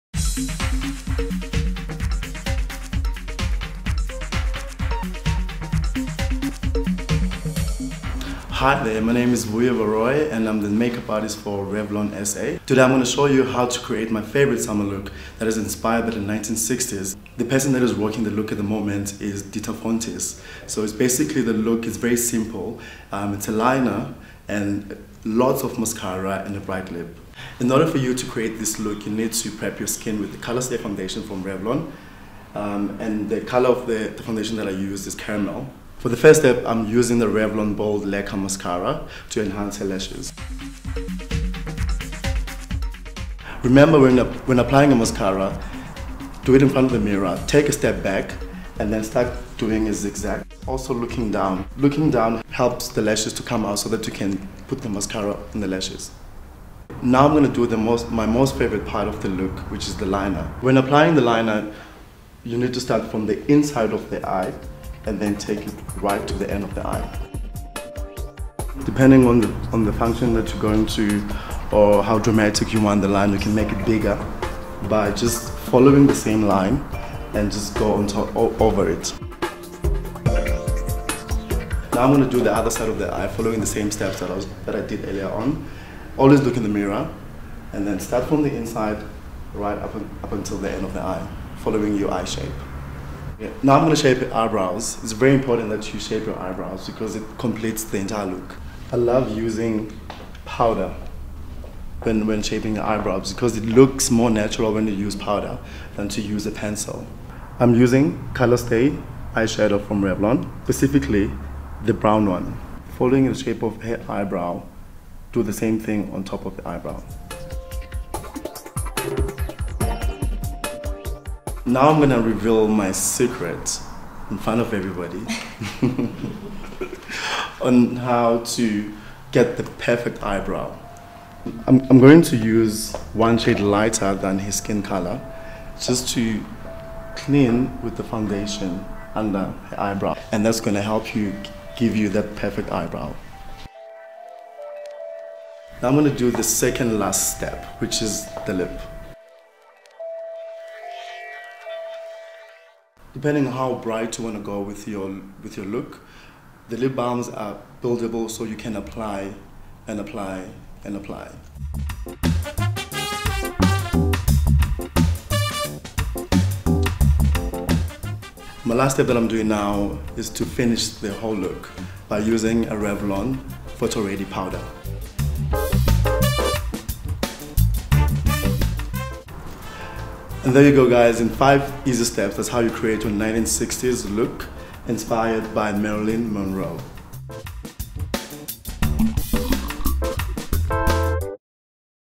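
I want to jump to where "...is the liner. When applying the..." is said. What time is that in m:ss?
0:59.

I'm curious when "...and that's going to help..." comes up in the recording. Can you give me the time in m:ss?
2:20.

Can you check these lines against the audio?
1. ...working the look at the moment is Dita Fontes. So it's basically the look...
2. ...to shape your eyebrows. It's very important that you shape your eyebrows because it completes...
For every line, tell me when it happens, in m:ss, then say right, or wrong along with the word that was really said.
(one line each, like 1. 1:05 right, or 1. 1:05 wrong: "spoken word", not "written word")
1. 0:17 right
2. 1:33 right.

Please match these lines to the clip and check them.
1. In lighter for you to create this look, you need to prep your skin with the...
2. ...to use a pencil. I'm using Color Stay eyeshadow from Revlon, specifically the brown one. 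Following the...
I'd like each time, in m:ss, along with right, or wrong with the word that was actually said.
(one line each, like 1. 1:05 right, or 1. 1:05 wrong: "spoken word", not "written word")
1. 0:27 wrong: "order", not "lighter"
2. 1:46 right.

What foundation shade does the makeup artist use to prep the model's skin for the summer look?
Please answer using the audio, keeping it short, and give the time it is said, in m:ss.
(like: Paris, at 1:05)
Caramel, at 0:35.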